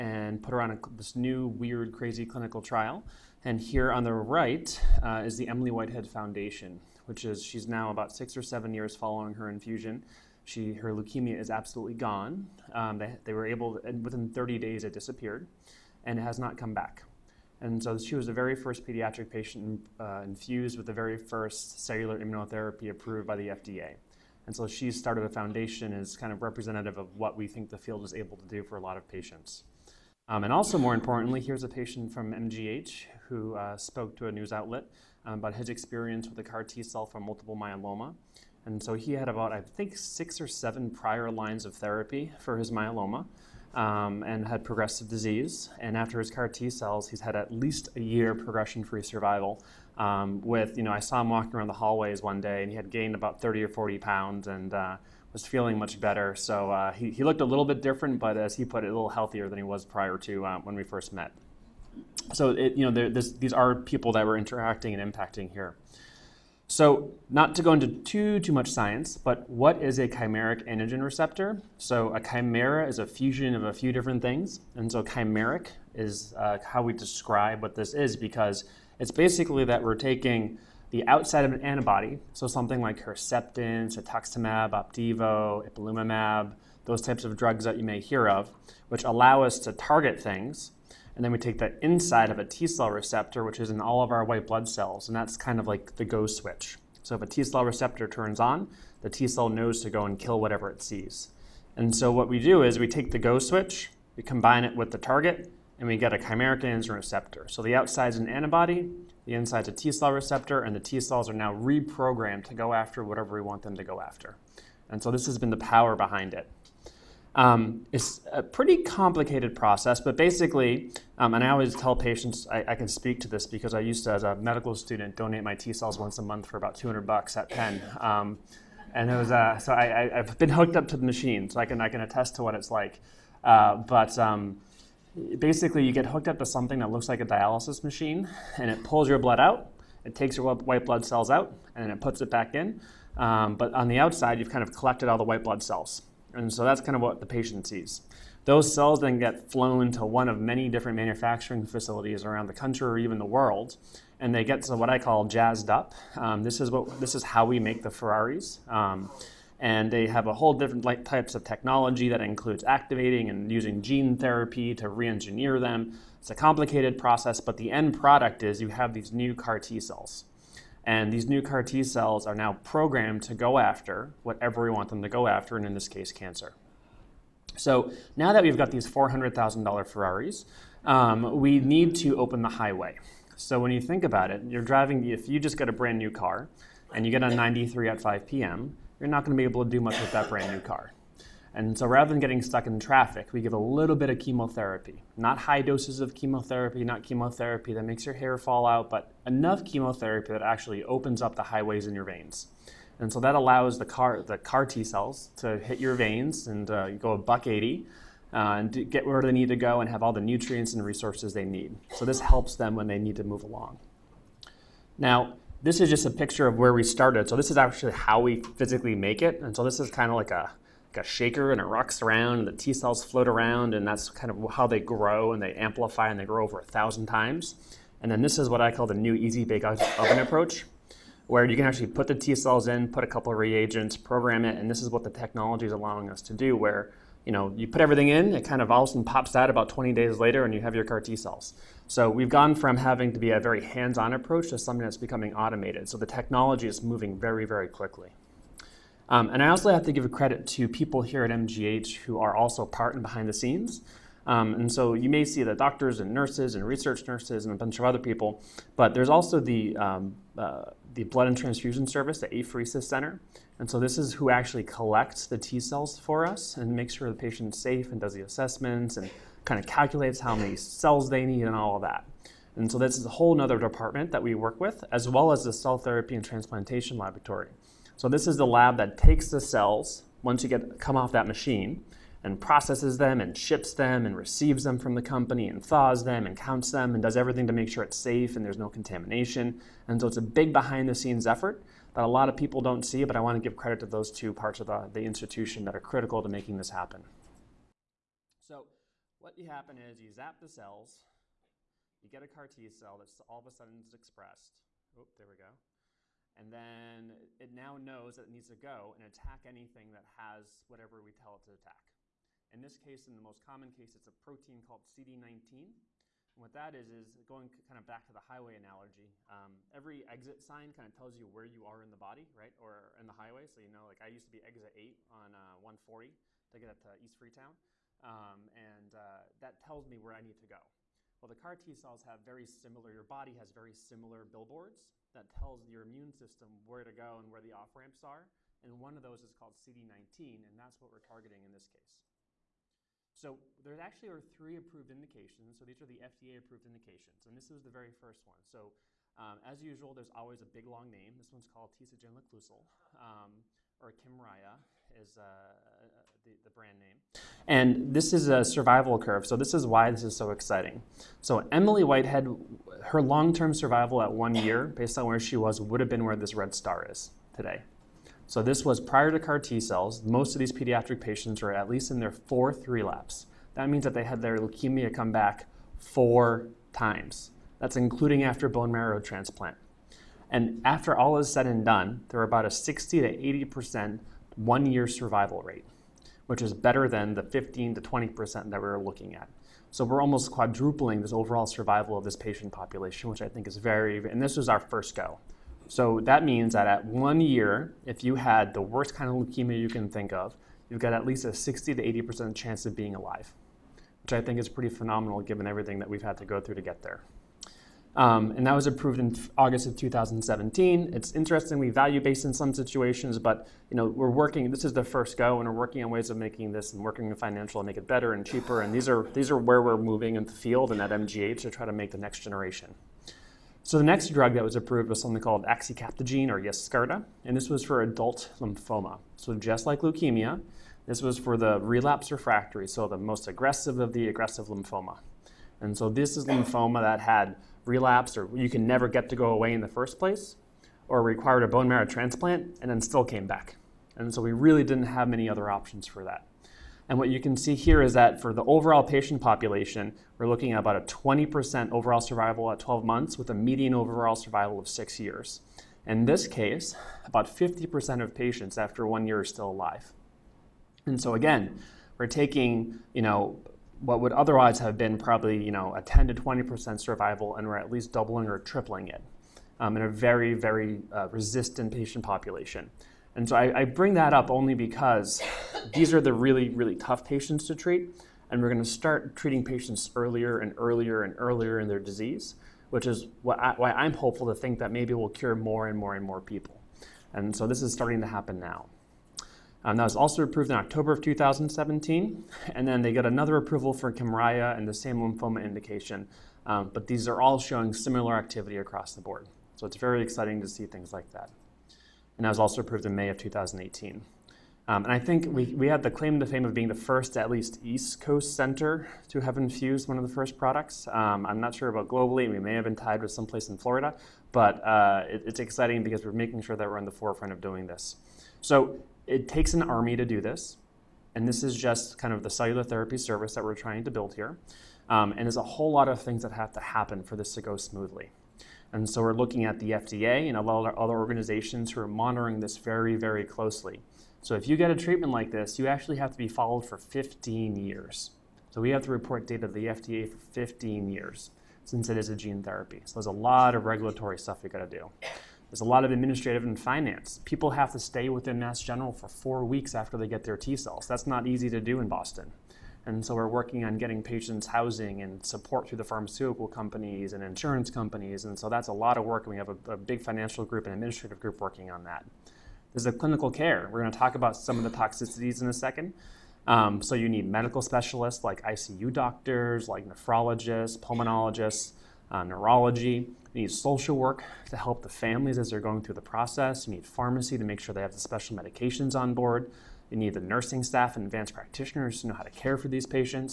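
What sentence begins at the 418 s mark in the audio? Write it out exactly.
And these are these are where we're moving in the field and at MGH to try to make the next generation.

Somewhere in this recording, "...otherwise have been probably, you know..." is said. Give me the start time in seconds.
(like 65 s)
464 s.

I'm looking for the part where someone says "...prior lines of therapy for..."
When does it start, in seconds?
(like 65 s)
40 s.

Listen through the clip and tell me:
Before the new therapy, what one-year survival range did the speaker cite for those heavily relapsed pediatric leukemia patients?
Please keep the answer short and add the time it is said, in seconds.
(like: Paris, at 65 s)
15 to 20%, at 387 s.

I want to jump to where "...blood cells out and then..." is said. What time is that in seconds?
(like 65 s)
140 s.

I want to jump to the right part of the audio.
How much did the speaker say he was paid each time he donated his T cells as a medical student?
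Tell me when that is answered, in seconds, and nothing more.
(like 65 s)
126 s.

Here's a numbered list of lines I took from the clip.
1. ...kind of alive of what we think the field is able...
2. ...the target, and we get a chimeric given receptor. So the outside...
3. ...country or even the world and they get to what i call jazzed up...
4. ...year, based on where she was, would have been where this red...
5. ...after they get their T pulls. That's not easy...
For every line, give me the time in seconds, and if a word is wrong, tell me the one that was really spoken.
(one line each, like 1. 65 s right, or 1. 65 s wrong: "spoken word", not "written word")
1. 26 s wrong: "representative", not "alive"
2. 104 s wrong: "antigen", not "given"
3. 152 s right
4. 364 s right
5. 549 s wrong: "cells", not "pulls".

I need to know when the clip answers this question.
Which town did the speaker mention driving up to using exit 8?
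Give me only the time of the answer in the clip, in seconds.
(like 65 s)
327 s.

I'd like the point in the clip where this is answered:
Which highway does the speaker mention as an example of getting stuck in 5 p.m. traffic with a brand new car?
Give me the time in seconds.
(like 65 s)
187 s.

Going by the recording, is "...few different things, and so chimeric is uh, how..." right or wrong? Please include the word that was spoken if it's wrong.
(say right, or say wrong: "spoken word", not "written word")
right.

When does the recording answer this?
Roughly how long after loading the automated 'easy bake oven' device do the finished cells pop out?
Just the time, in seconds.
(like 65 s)
239 s.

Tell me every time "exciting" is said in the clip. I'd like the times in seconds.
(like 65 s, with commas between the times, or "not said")
360 s, 500 s, 515 s.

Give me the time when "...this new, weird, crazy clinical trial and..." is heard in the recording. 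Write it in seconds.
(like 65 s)
0 s.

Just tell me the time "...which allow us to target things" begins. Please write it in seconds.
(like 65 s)
88 s.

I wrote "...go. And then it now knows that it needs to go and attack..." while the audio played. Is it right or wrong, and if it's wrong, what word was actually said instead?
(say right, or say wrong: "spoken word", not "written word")
right.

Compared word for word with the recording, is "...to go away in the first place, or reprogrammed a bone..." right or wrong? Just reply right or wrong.
wrong.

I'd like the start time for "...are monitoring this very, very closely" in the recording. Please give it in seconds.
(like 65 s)
531 s.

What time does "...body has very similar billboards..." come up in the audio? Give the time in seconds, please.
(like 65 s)
333 s.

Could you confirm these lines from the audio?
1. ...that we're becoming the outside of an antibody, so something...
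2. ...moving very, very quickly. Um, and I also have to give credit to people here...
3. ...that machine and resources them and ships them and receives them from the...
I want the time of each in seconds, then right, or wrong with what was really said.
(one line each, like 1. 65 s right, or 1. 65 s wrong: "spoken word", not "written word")
1. 79 s wrong: "taking", not "becoming"
2. 246 s right
3. 281 s wrong: "processes", not "resources".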